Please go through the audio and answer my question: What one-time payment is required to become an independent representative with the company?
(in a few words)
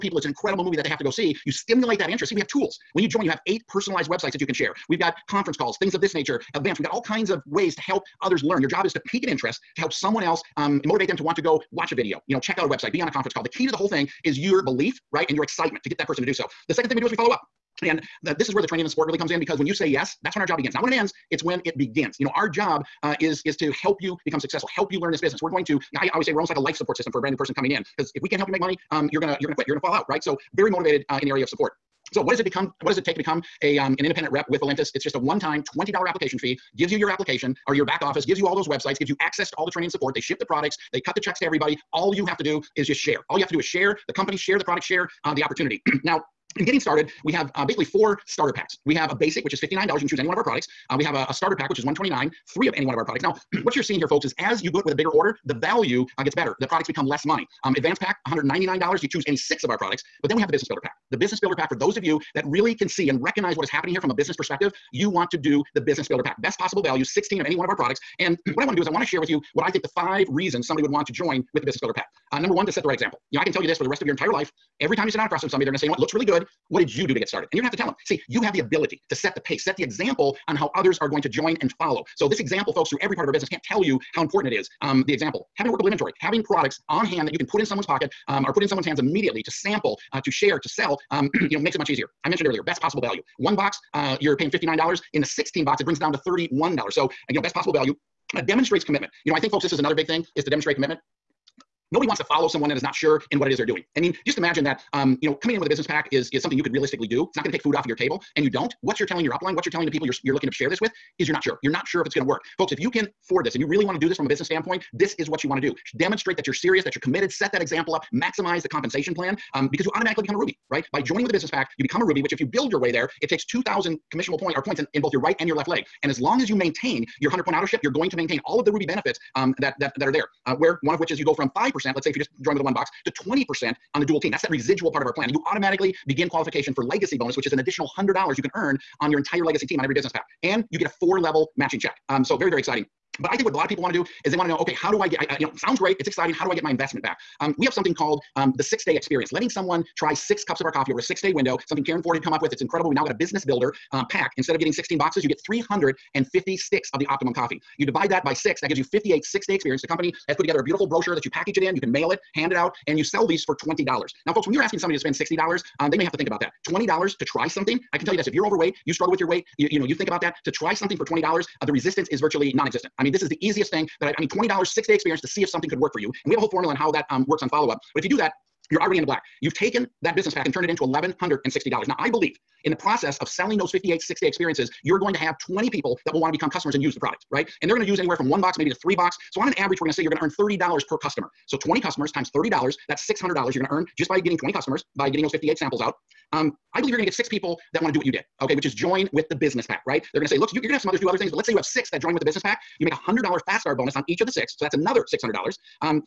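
$20 application fee.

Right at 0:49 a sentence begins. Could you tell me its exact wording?
You can choose any one of our products.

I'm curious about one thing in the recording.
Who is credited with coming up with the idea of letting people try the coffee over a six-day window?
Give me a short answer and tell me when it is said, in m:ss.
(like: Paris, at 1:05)
Karen Ford, at 2:31.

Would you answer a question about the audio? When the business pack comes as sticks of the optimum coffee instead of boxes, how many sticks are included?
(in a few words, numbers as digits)
350.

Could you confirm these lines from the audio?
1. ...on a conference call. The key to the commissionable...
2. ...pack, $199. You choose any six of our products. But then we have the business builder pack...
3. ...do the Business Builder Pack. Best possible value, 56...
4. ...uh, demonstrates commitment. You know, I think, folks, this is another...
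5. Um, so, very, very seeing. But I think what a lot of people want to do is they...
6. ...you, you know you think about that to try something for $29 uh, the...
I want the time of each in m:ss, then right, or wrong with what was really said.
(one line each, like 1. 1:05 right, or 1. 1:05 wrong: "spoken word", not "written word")
1. 0:13 wrong: "whole", not "commissionable"
2. 0:57 right
3. 1:05 wrong: "16", not "56"
4. 1:38 right
5. 2:22 wrong: "exciting", not "seeing"
6. 2:49 wrong: "20", not "29".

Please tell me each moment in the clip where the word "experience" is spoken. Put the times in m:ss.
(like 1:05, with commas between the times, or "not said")
2:28, 2:39, 2:54, 3:04.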